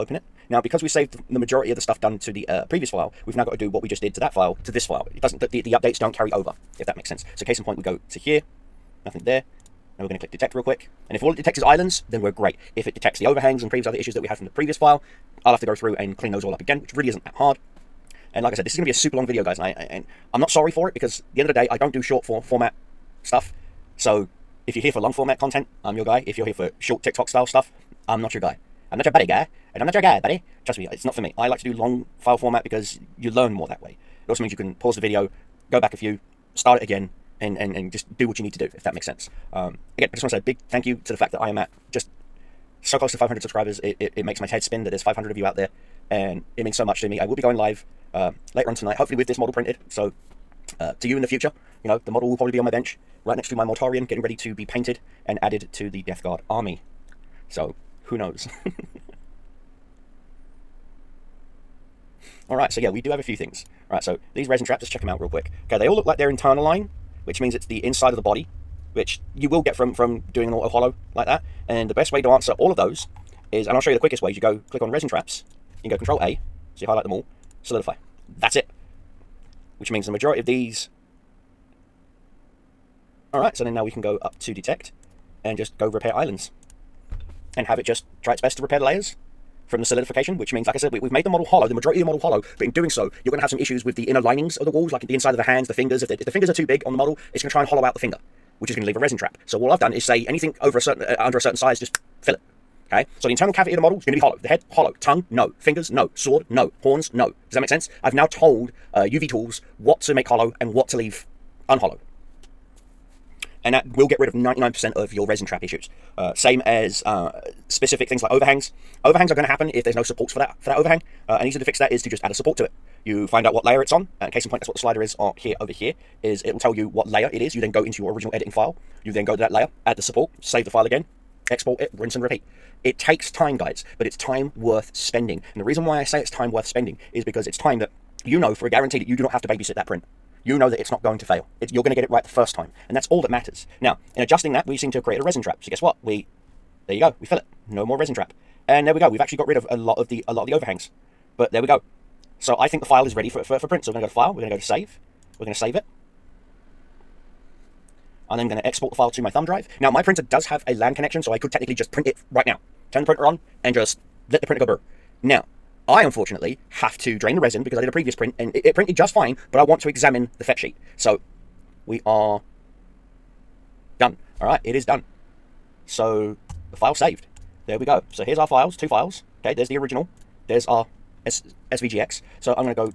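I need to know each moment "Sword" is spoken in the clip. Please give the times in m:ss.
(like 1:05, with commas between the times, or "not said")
1:46.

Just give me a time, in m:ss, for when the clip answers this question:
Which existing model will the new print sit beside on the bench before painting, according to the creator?
0:53.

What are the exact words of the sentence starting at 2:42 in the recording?
Turn the printer on and just let the printer go burr.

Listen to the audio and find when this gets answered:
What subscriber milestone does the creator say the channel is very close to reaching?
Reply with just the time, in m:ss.
0:43.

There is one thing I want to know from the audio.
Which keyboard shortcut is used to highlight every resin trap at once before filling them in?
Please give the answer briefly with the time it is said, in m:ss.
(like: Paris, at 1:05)
Control A, at 1:15.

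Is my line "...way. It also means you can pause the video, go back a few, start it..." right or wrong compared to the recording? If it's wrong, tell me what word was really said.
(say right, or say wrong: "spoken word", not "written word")
right.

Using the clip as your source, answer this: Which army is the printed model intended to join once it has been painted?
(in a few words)
Death Guard.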